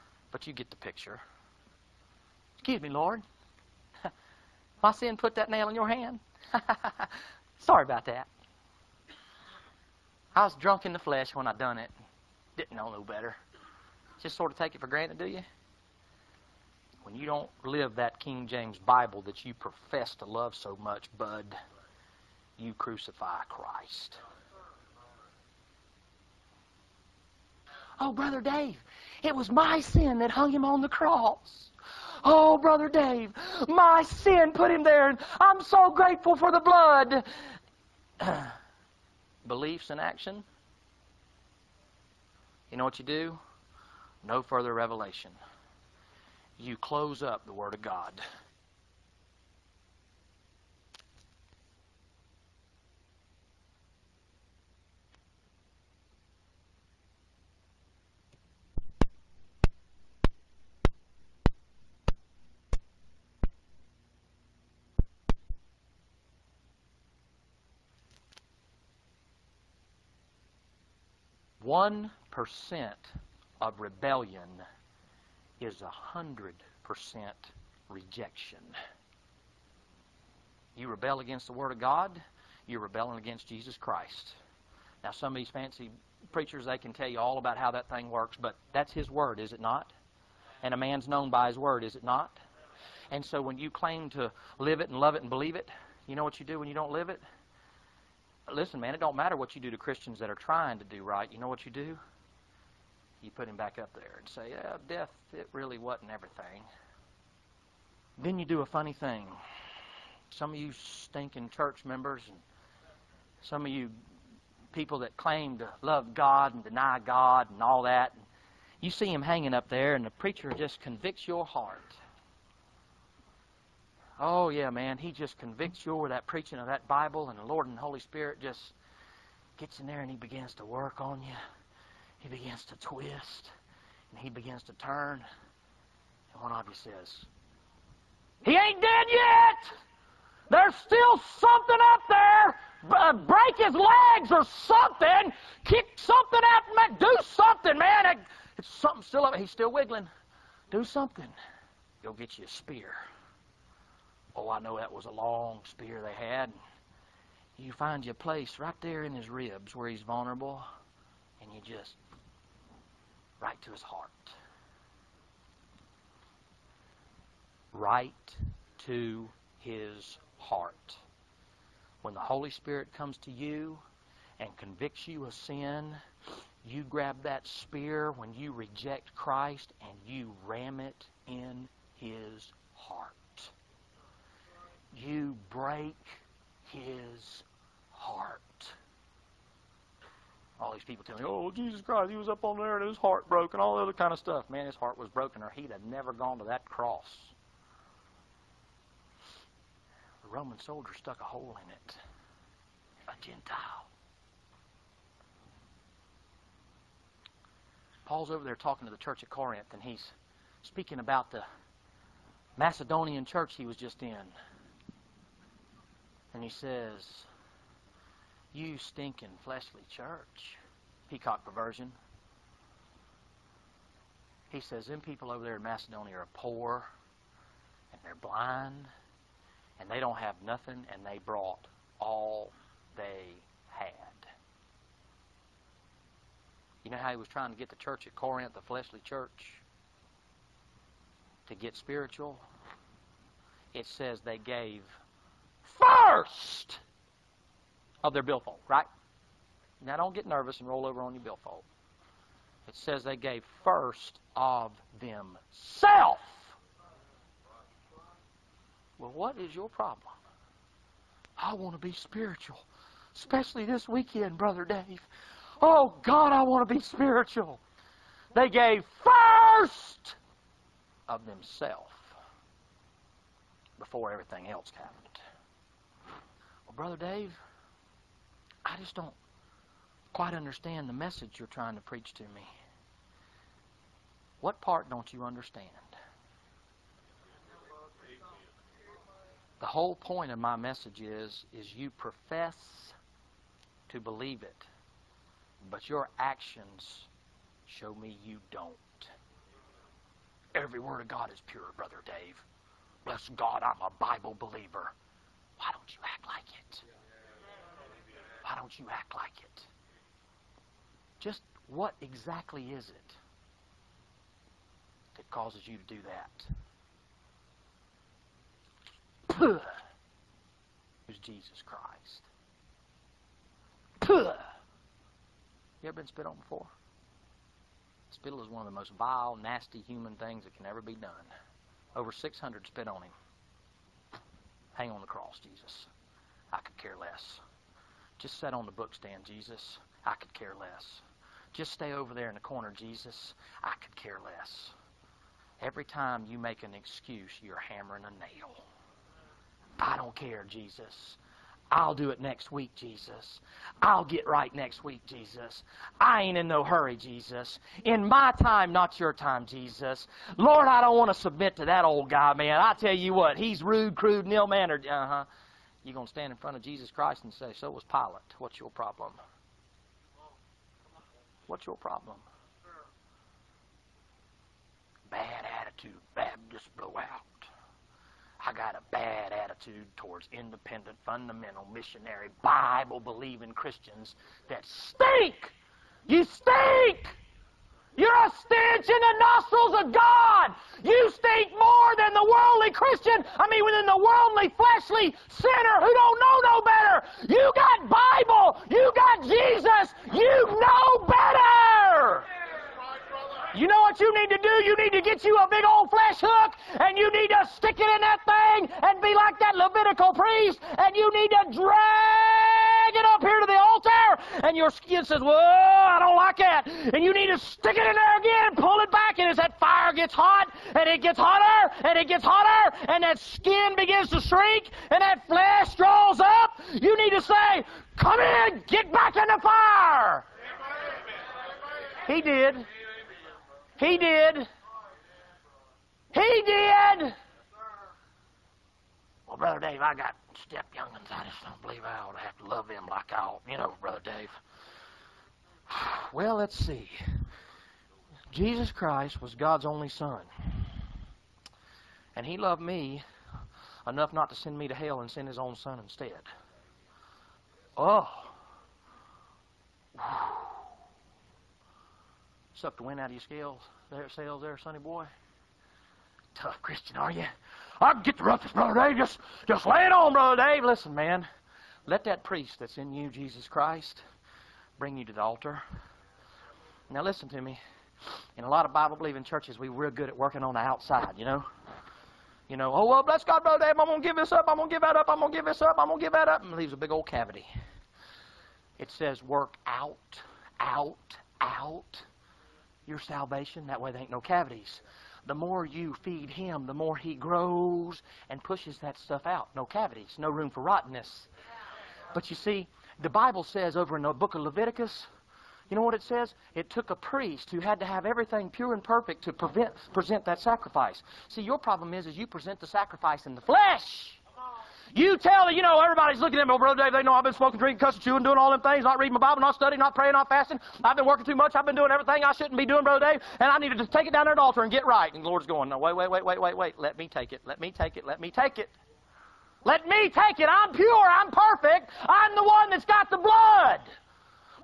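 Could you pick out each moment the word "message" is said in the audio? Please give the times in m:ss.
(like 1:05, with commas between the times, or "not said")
4:40, 4:50.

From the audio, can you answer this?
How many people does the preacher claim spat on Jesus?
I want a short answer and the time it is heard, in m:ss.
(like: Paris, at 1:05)
Over 600, at 5:31.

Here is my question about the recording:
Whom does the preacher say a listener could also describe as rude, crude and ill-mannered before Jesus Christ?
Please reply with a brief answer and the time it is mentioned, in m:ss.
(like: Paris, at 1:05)
Pilate, at 6:07.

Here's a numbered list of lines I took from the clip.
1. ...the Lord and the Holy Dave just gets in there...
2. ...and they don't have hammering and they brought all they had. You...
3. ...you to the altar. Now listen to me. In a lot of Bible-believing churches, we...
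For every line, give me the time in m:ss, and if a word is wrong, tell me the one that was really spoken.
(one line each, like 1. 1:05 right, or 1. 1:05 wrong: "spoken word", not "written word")
1. 2:07 wrong: "Spirit", not "Dave"
2. 3:49 wrong: "nothing", not "hammering"
3. 7:54 right.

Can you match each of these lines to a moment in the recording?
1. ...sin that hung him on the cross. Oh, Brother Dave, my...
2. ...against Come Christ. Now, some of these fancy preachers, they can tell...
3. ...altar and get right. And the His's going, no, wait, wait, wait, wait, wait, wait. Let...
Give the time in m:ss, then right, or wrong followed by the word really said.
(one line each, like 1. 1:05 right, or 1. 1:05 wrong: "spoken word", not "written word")
1. 0:29 right
2. 1:23 wrong: "Jesus", not "Come"
3. 8:44 wrong: "Lord", not "His".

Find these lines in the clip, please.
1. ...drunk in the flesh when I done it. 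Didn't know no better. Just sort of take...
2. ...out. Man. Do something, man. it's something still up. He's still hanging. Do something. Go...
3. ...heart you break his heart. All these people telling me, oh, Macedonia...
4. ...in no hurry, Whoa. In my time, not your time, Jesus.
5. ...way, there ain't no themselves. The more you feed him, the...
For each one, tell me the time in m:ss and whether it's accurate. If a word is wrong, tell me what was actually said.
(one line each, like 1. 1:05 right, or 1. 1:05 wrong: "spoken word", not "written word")
1. 0:10 right
2. 2:26 wrong: "wiggling", not "hanging"
3. 3:02 wrong: "Jesus", not "Macedonia"
4. 5:56 wrong: "Jesus", not "Whoa"
5. 8:13 wrong: "cavities", not "themselves".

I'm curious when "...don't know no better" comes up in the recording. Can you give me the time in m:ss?
6:35.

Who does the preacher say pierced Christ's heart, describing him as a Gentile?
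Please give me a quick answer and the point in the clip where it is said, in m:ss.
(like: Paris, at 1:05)
The Roman soldier, at 3:20.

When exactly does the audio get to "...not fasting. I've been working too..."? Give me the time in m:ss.
8:40.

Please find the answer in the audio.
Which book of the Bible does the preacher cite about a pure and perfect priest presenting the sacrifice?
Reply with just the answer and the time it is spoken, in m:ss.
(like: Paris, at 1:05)
Leviticus, at 8:24.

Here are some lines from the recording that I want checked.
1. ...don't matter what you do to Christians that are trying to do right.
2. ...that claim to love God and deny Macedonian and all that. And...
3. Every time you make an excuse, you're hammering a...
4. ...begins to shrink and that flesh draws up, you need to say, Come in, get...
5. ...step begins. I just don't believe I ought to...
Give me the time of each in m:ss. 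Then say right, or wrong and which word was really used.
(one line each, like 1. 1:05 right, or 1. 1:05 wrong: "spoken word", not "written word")
1. 1:38 right
2. 1:54 wrong: "God", not "Macedonian"
3. 5:45 right
4. 7:03 right
5. 7:20 wrong: "youngins", not "begins".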